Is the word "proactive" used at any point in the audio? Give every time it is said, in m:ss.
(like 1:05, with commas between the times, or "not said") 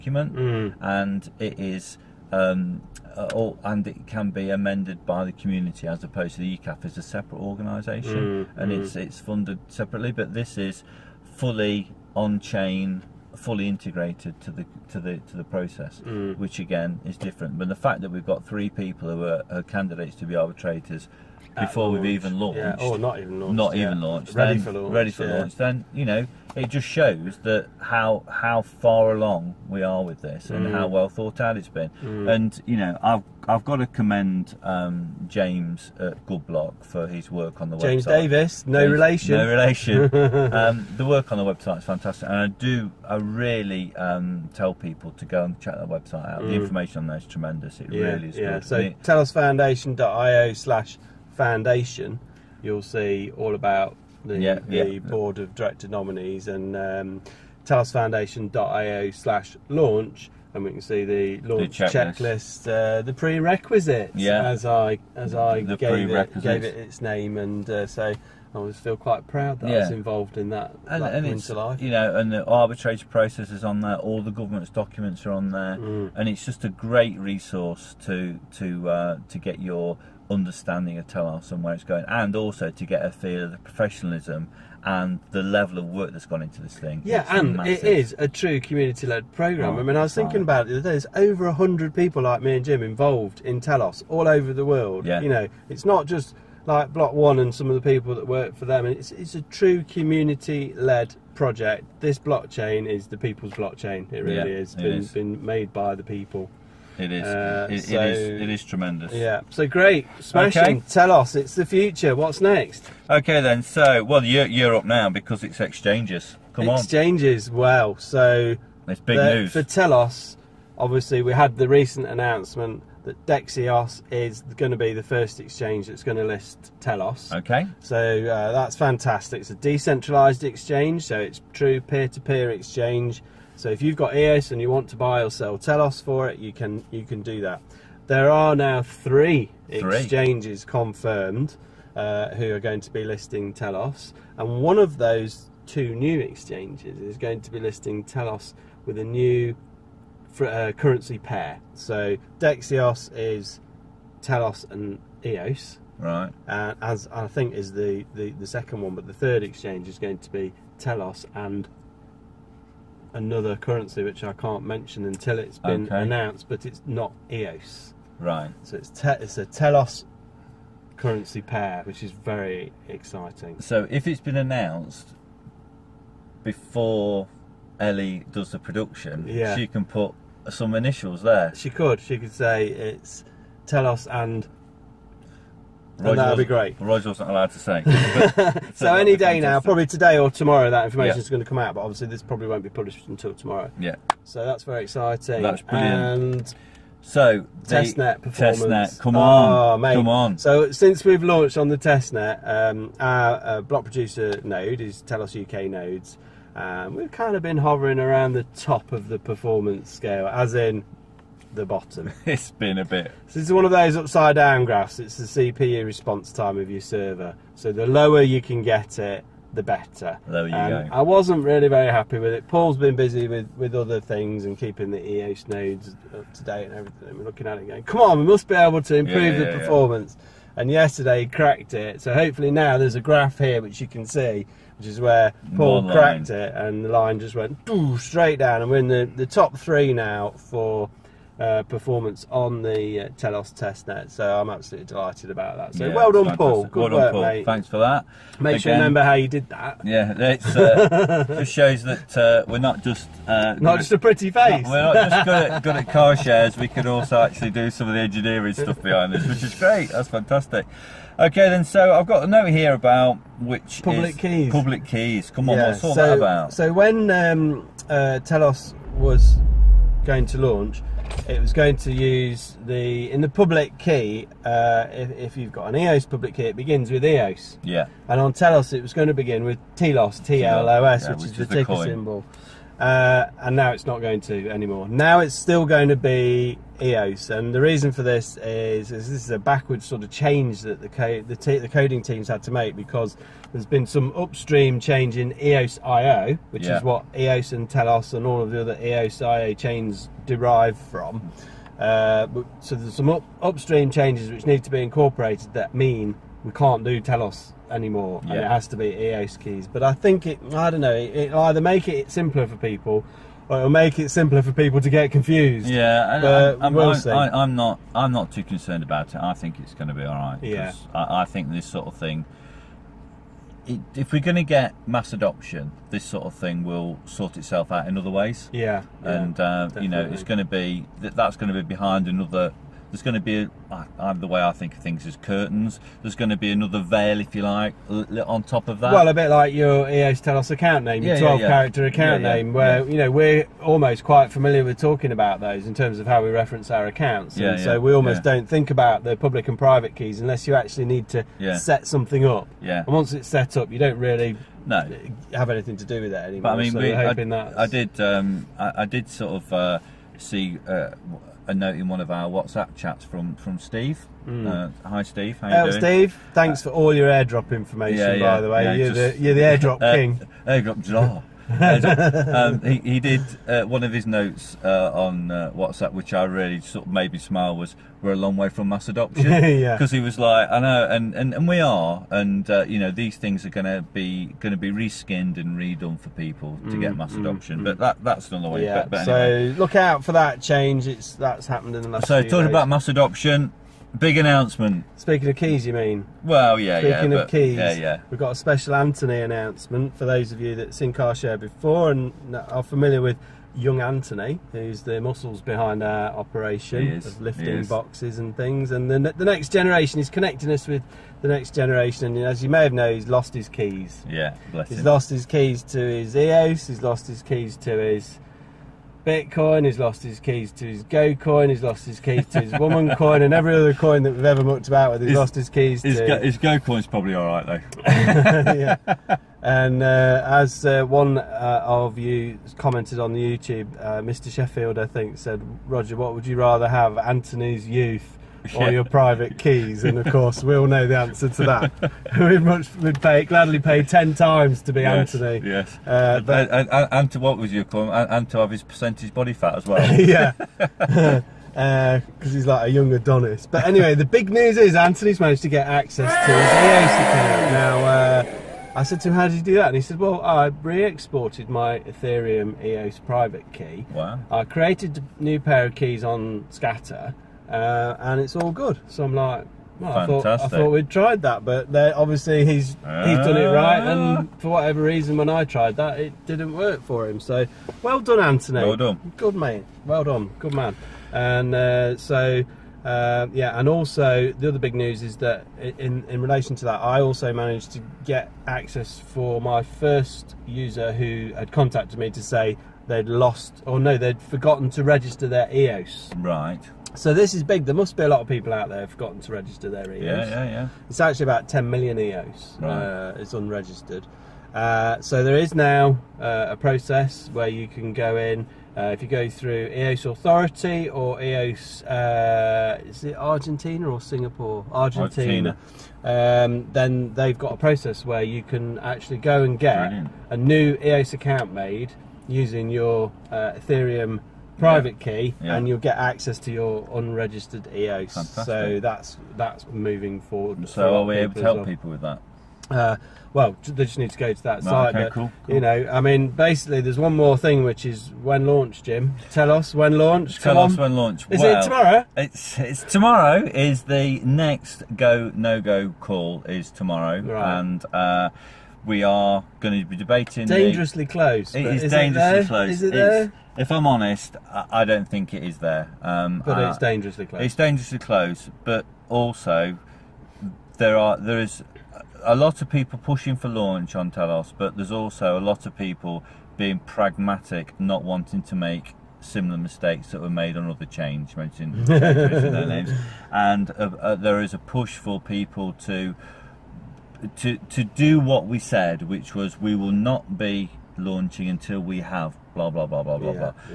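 not said.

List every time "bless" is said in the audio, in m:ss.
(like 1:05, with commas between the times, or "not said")
6:54.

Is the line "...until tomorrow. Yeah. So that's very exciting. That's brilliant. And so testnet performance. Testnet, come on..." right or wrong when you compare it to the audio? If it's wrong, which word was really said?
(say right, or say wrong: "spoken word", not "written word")
right.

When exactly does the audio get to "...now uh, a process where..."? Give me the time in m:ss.
8:25.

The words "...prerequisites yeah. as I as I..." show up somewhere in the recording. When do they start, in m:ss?
1:03.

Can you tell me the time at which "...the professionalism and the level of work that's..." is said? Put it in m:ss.
1:23.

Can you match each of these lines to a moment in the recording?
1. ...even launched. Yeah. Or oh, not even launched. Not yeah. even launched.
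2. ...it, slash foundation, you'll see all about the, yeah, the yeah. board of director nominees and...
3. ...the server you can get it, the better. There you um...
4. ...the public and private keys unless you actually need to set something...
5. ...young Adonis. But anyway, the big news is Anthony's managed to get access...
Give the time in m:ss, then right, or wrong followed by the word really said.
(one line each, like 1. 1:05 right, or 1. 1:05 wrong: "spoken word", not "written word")
1. 0:22 right
2. 0:48 right
3. 3:37 wrong: "lower", not "server"
4. 5:49 right
5. 7:32 right.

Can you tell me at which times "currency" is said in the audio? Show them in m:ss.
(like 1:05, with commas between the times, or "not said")
2:30, 2:43, 2:50.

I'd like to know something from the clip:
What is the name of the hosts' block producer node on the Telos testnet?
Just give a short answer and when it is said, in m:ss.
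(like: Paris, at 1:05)
Telos UK, at 3:25.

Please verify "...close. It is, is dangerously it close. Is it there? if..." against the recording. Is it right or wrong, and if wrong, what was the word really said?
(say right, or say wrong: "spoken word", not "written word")
right.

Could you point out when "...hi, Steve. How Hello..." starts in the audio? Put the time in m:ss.
6:04.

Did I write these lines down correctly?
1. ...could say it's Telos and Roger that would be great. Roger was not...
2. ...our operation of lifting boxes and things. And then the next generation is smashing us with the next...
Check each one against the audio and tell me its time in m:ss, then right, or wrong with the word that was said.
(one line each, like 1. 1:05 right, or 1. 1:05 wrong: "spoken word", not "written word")
1. 3:02 right
2. 6:45 wrong: "connecting", not "smashing".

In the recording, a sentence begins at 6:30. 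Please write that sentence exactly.
It's that's happened in the last.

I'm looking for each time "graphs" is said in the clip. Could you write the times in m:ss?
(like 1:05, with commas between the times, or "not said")
3:34, 3:52.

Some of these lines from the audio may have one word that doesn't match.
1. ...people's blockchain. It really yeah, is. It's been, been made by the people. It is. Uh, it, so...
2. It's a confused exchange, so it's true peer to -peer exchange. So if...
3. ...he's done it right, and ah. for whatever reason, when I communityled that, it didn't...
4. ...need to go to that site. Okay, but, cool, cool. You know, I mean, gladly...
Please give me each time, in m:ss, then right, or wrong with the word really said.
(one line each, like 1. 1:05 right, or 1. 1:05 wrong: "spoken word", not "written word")
1. 1:43 right
2. 2:09 wrong: "decentralized", not "confused"
3. 7:52 wrong: "tried", not "communityled"
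4. 8:53 wrong: "basically", not "gladly".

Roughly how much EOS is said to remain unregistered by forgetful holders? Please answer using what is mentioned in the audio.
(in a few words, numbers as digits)
10 million EOS.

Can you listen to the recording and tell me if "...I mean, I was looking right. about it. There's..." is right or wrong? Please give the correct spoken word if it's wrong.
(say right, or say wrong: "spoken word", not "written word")
wrong: "thinking", not "looking".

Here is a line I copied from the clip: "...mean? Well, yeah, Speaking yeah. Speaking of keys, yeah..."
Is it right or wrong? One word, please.
right.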